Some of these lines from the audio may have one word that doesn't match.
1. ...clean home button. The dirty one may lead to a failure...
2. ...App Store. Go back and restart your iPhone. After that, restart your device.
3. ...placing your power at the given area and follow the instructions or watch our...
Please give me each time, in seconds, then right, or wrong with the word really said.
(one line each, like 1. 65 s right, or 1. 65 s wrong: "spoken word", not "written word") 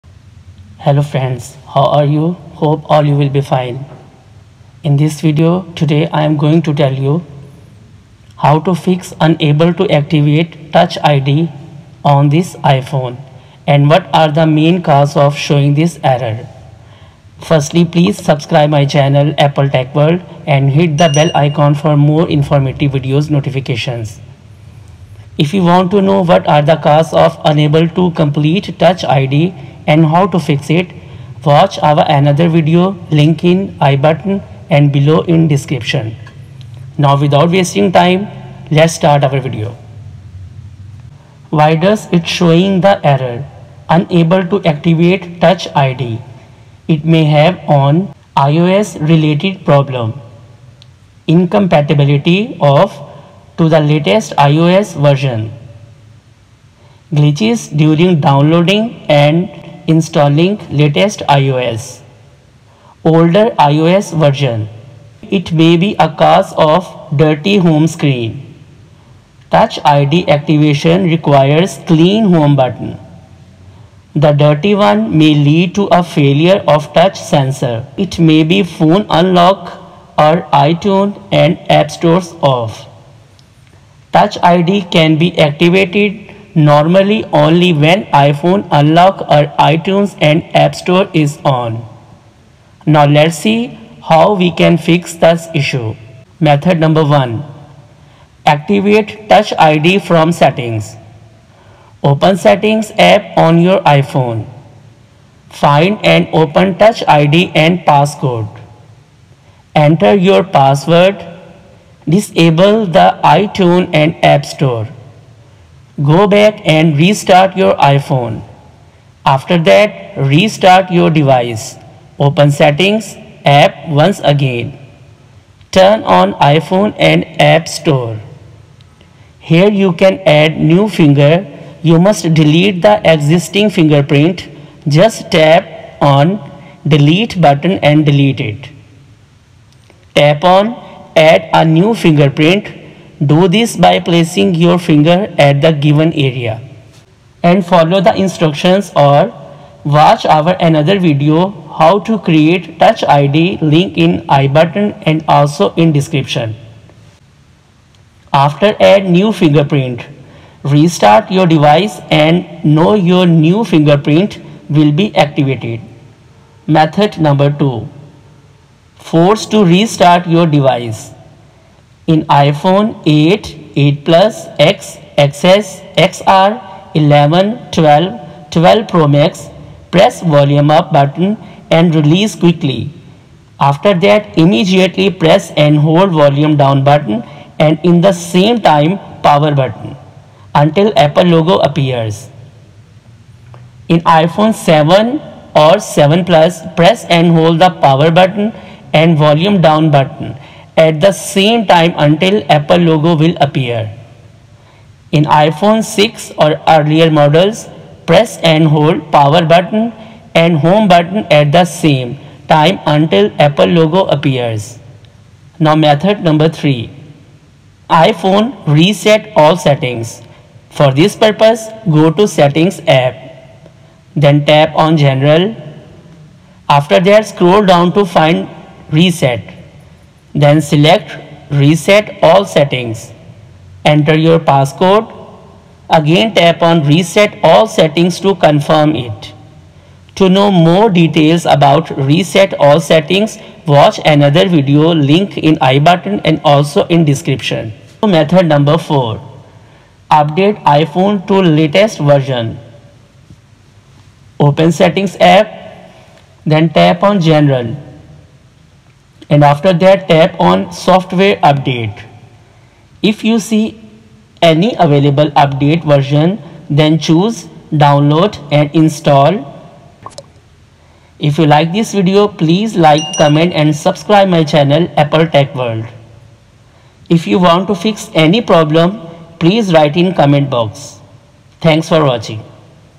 1. 71 s right
2. 114 s right
3. 143 s wrong: "finger", not "power".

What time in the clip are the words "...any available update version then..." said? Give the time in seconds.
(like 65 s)
264 s.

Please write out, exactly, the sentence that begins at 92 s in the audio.
Now let's see how we can fix this issue.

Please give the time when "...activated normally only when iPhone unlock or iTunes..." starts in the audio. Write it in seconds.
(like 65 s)
85 s.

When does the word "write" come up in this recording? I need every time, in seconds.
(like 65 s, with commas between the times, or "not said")
279 s.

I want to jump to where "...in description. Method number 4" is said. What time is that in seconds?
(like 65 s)
246 s.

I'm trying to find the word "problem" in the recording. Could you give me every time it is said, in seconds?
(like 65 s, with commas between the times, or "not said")
49 s, 278 s.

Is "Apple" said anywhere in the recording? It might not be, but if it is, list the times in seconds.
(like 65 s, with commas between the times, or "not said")
19 s, 190 s, 202 s, 213 s, 274 s.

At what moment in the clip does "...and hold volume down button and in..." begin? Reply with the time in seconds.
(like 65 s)
185 s.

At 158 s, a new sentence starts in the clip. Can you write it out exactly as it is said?
After add new fingerprint, restart your device and know your new fingerprint will be activated.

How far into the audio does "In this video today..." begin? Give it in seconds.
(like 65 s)
4 s.